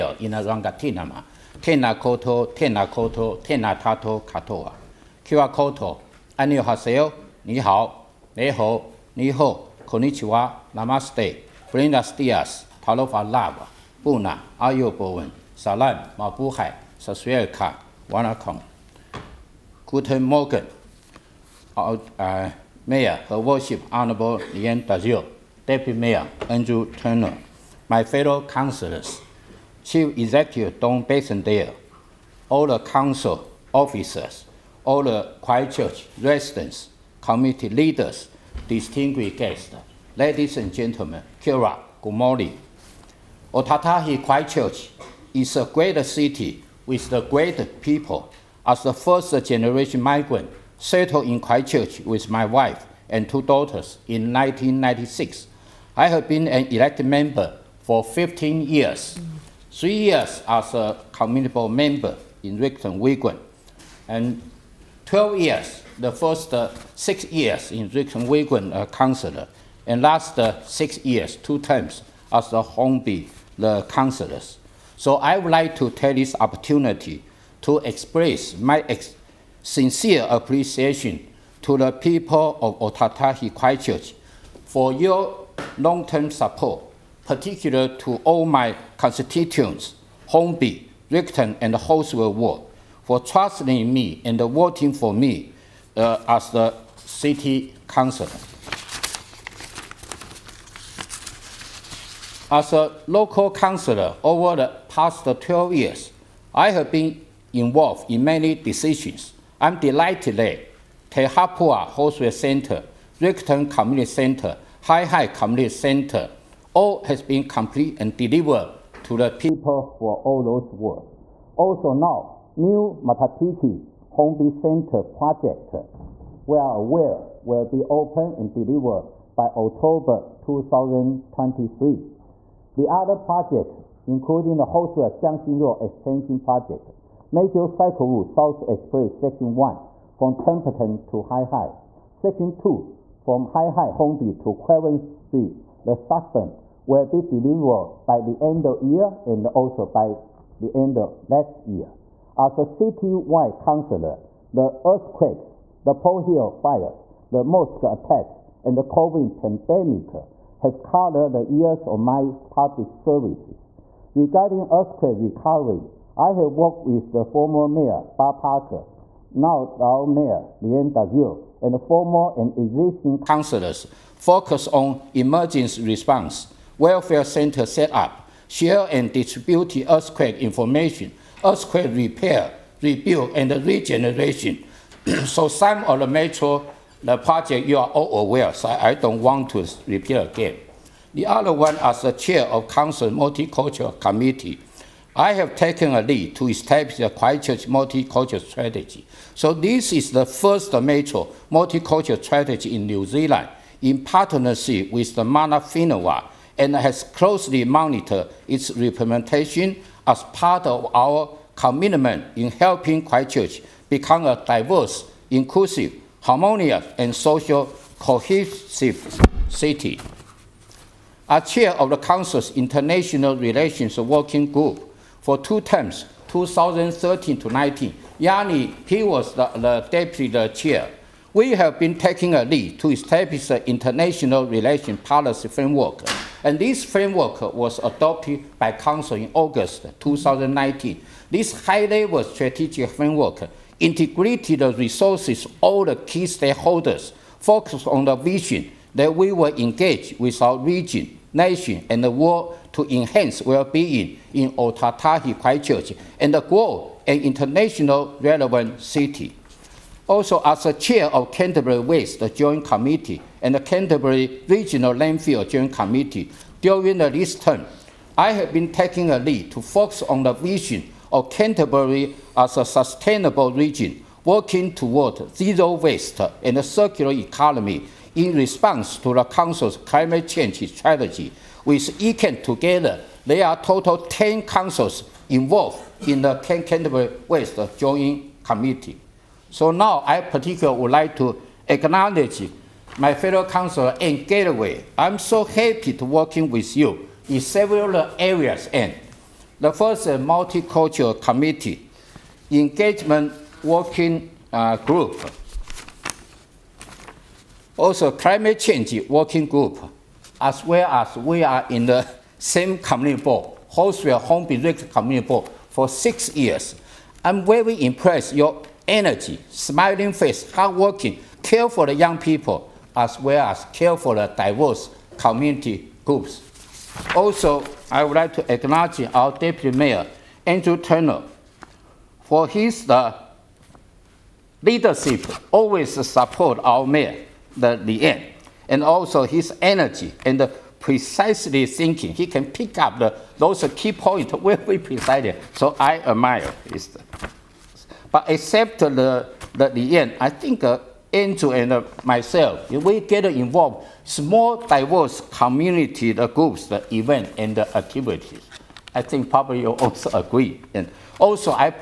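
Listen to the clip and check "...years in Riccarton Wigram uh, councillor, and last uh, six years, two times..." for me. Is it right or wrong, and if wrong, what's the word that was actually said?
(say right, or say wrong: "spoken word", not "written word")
right.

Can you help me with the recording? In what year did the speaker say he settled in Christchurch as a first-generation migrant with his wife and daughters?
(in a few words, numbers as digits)
1996.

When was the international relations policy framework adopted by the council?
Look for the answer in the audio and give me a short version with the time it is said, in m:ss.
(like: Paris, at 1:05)
August 2019, at 3:59.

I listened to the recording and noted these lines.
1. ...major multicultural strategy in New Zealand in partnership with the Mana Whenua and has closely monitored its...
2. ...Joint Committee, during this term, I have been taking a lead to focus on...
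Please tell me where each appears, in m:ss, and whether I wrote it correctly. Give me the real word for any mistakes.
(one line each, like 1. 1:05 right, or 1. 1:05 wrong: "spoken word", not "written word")
1. 3:20 right
2. 4:25 right.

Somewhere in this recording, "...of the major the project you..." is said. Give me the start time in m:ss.
3:05.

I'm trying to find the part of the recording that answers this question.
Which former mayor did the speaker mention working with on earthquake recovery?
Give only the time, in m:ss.
2:48.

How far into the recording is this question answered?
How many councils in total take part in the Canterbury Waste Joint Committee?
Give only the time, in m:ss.
4:43.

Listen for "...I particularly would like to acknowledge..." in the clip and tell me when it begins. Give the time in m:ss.
4:50.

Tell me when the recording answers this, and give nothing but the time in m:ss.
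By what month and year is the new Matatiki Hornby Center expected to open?
2:09.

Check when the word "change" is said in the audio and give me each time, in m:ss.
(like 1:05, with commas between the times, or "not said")
4:40, 5:08.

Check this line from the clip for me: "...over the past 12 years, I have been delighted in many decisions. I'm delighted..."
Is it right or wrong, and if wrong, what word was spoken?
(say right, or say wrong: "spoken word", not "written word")
wrong: "involved", not "delighted".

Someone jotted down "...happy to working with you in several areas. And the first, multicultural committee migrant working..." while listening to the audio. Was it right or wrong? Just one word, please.
wrong.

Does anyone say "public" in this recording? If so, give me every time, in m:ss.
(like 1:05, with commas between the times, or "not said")
2:42.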